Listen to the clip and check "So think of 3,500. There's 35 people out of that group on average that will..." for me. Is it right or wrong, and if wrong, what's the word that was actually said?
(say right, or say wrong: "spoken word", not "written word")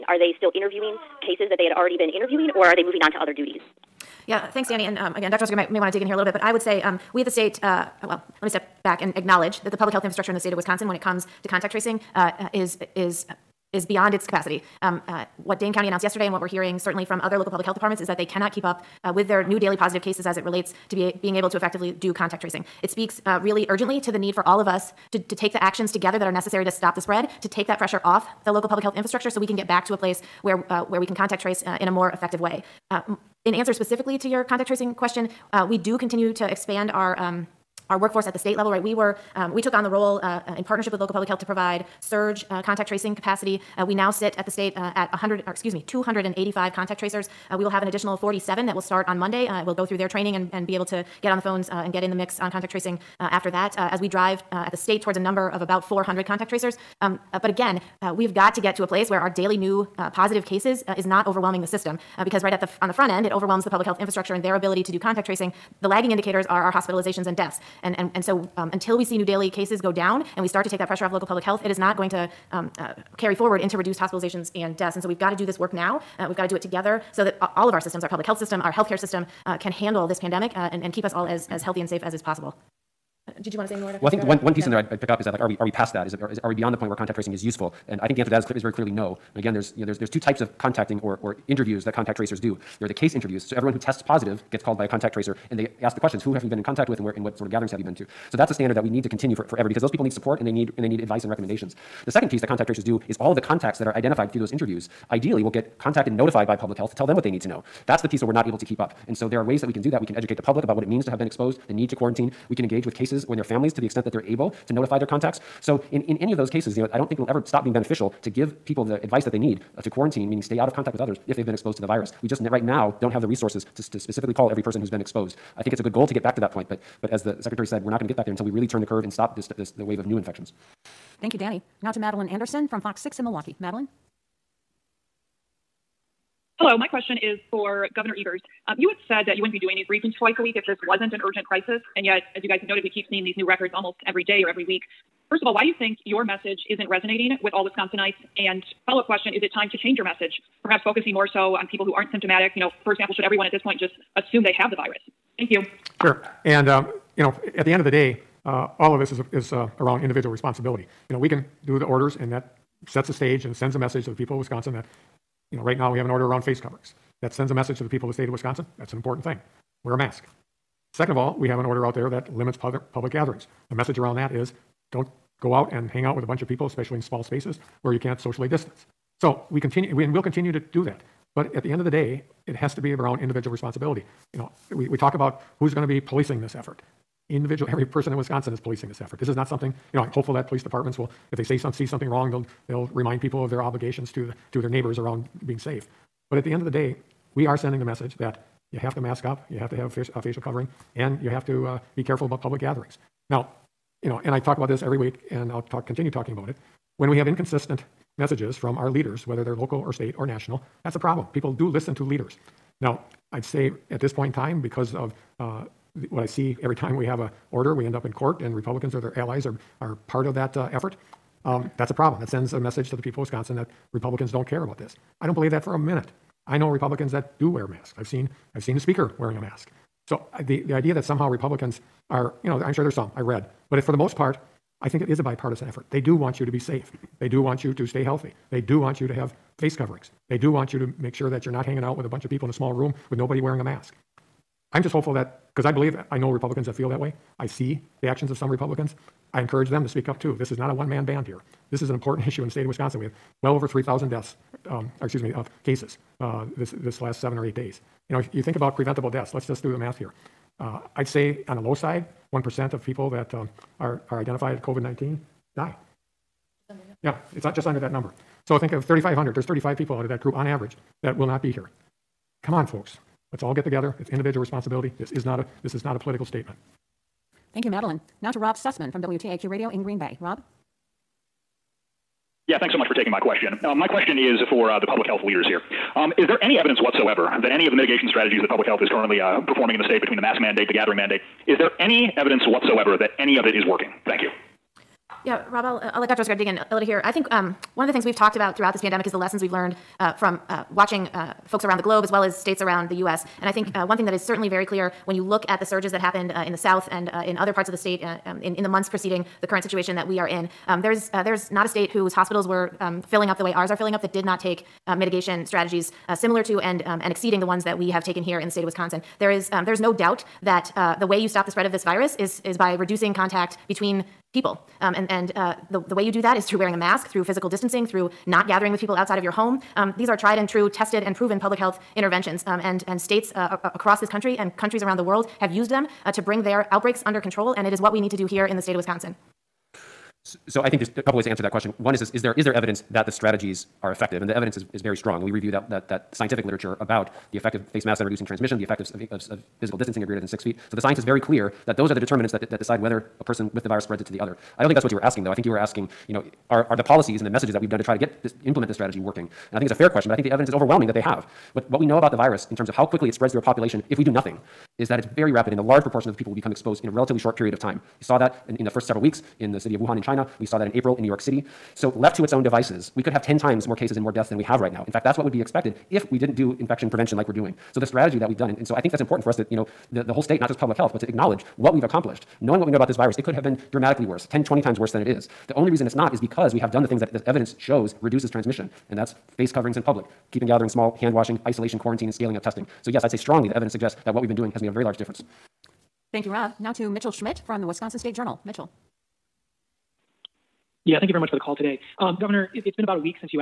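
right.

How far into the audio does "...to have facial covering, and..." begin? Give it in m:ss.
3:19.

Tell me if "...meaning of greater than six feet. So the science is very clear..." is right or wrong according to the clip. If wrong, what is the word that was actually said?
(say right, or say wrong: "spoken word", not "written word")
wrong: "distancing", not "meaning".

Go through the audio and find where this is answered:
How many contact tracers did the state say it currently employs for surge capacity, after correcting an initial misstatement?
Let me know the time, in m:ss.
0:45.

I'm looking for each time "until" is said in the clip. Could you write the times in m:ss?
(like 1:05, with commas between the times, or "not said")
1:08, 2:08.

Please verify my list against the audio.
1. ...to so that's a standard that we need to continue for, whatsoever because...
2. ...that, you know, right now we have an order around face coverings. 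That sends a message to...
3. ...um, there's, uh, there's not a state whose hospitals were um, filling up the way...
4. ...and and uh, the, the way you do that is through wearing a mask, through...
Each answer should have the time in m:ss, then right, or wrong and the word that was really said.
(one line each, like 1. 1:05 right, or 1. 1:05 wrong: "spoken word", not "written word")
1. 1:37 wrong: "forever", not "whatsoever"
2. 2:44 right
3. 5:10 right
4. 5:24 right.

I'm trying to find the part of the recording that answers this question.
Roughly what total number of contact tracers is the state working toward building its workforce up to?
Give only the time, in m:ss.
0:55.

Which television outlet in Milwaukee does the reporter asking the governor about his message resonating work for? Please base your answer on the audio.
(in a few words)
Fox 6.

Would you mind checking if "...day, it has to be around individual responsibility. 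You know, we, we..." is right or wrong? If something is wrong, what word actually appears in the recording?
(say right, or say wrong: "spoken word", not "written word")
right.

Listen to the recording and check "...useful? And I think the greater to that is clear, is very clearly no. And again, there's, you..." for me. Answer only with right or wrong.
wrong.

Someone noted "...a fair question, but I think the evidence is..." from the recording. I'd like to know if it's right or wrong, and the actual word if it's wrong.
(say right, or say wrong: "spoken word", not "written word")
right.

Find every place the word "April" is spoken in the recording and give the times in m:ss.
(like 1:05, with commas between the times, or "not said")
6:10.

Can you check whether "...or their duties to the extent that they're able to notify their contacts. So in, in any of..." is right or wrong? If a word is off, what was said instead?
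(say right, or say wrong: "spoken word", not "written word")
wrong: "families", not "duties".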